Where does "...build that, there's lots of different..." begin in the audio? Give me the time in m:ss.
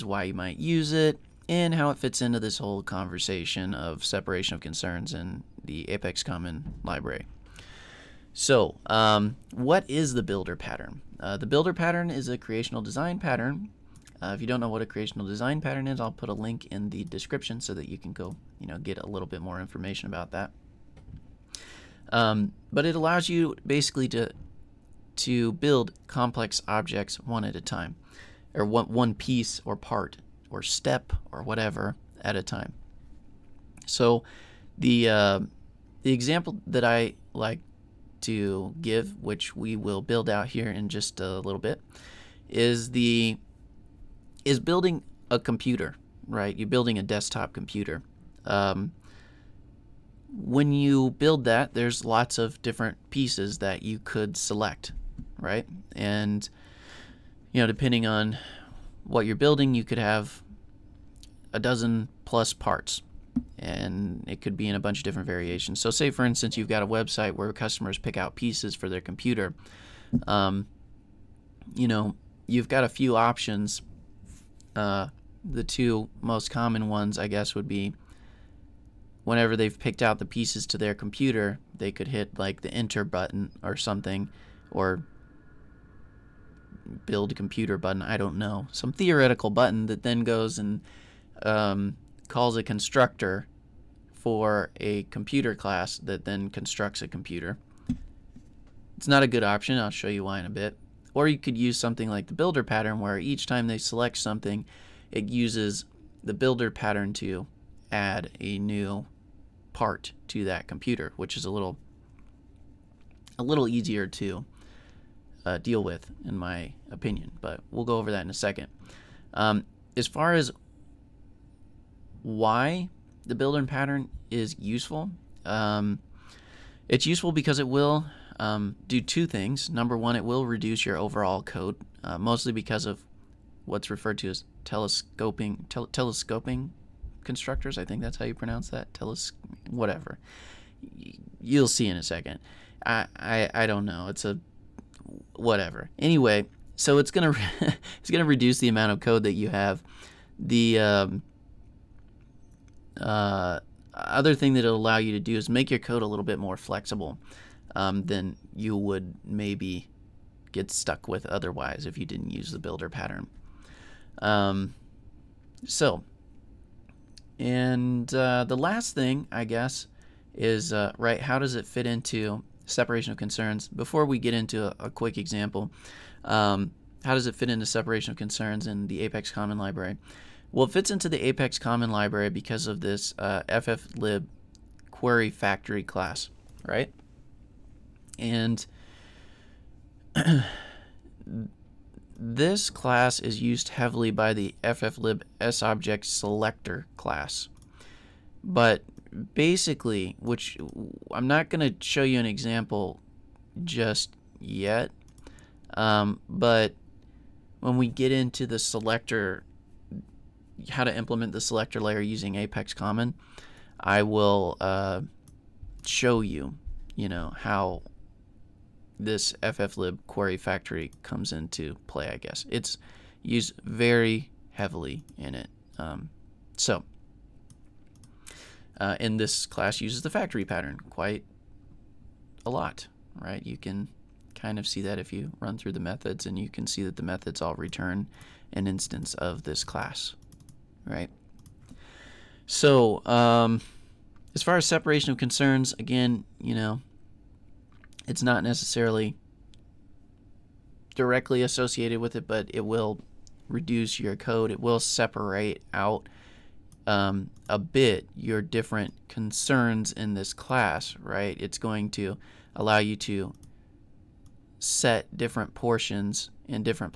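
0:51.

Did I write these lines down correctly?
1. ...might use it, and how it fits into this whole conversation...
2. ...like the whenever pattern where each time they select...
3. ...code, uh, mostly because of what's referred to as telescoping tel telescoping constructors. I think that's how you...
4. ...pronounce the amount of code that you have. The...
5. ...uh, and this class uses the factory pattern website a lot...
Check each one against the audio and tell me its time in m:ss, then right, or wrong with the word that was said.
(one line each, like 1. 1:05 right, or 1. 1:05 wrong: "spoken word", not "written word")
1. 0:00 right
2. 1:42 wrong: "builder", not "whenever"
3. 2:11 right
4. 2:28 wrong: "reduce", not "pronounce"
5. 3:48 wrong: "quite", not "website".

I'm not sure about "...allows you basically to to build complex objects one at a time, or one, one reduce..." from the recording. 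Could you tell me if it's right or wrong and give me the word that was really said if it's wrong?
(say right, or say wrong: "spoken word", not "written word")
wrong: "piece", not "reduce".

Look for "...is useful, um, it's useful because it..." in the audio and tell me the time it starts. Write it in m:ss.
2:04.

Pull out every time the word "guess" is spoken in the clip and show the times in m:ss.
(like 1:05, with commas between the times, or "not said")
1:17, 2:49, 3:42.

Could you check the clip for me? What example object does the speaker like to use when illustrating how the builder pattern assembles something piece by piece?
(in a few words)
a desktop computer.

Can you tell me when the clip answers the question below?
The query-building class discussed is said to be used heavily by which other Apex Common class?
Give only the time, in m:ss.
3:14.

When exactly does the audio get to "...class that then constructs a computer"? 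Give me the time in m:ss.
1:35.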